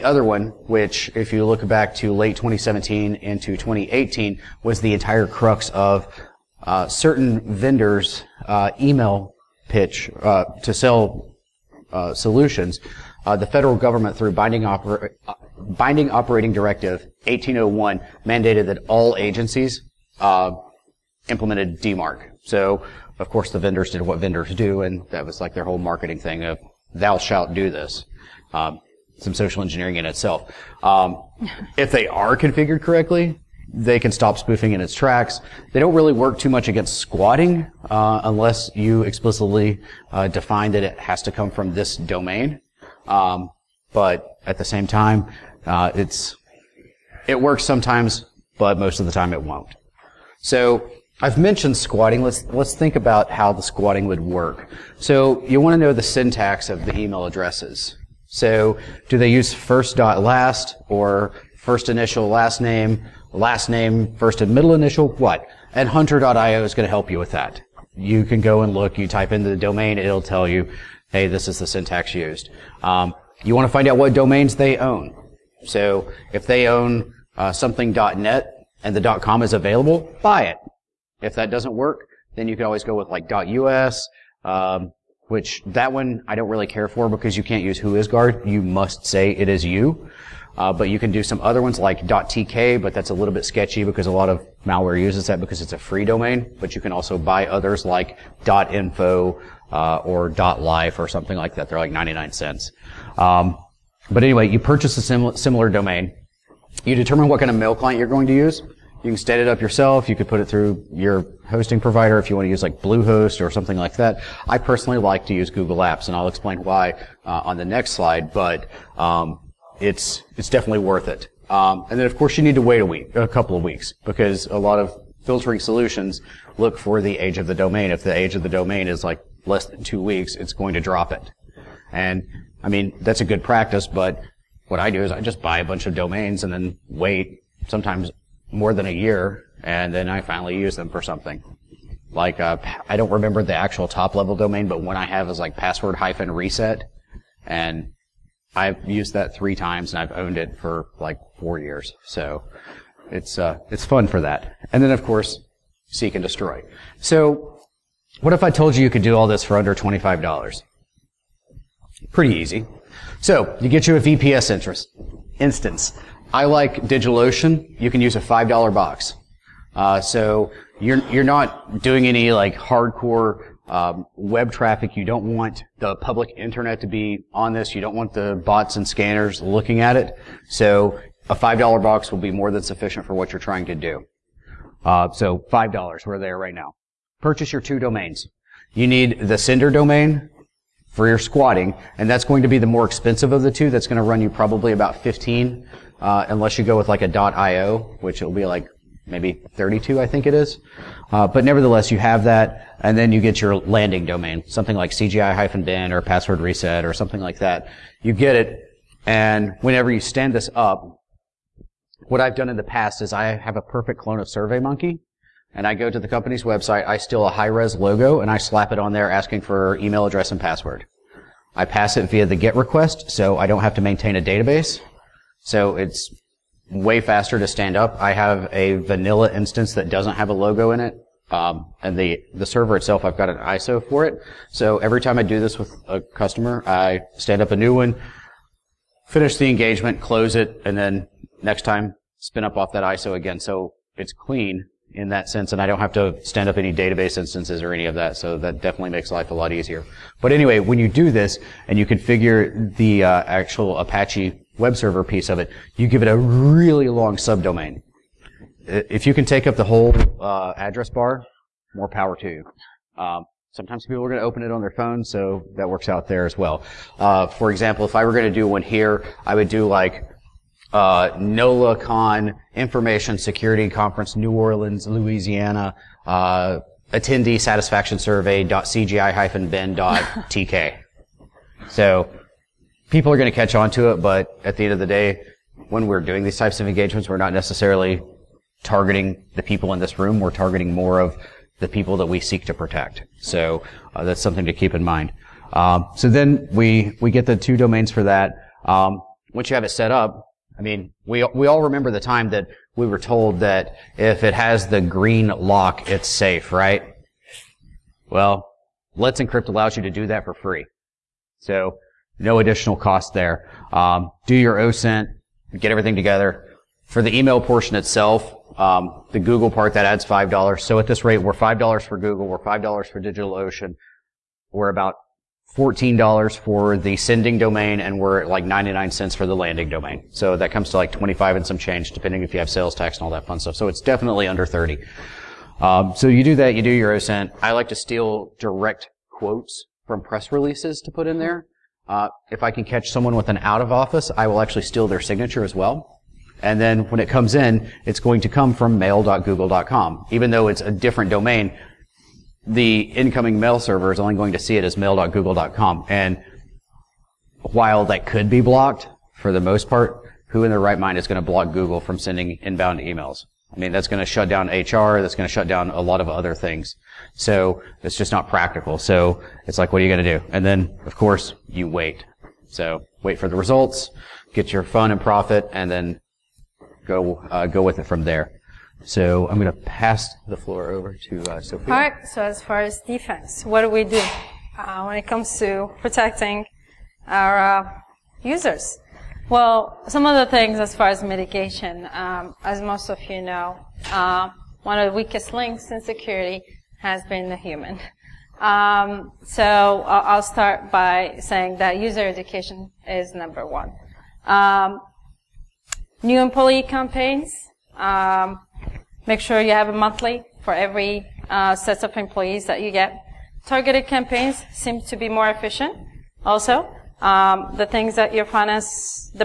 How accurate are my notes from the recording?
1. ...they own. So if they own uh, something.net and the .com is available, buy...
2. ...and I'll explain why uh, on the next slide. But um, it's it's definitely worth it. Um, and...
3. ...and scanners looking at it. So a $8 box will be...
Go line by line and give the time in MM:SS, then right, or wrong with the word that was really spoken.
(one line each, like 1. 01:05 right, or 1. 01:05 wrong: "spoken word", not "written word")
1. 01:14 right
2. 01:56 right
3. 02:58 wrong: "5", not "8".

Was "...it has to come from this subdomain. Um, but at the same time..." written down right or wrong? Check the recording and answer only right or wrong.
wrong.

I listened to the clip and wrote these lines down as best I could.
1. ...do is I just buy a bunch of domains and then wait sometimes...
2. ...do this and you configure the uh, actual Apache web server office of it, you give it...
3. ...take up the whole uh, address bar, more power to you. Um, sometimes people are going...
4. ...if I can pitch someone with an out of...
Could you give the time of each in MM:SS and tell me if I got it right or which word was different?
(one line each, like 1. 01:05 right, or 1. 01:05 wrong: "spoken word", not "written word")
1. 02:14 right
2. 04:10 wrong: "piece", not "office"
3. 04:19 right
4. 05:42 wrong: "catch", not "pitch".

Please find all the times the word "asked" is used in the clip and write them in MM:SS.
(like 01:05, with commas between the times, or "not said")
not said.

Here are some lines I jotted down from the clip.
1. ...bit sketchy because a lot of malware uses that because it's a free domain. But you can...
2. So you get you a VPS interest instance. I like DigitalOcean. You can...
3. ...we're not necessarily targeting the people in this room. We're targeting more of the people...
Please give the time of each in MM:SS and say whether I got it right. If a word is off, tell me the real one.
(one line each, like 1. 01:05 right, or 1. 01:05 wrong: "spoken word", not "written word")
1. 01:33 right
2. 02:43 right
3. 04:47 right.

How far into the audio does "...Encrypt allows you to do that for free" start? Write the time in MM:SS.
05:09.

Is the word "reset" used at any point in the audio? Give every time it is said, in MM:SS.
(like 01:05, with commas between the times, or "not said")
02:26, 03:26.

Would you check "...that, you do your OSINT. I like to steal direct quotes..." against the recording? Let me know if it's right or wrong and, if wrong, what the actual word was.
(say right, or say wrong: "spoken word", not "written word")
right.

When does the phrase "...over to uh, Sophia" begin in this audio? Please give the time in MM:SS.
06:20.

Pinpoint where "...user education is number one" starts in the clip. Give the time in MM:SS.
06:41.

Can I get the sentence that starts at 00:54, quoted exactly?
So you want to know the syntax of the email addresses.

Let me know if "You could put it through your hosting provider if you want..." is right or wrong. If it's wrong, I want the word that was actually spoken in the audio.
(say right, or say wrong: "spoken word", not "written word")
right.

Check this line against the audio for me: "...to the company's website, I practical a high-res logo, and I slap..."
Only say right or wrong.
wrong.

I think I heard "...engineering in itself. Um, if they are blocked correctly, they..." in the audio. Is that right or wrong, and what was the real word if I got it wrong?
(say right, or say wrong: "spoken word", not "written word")
wrong: "configured", not "blocked".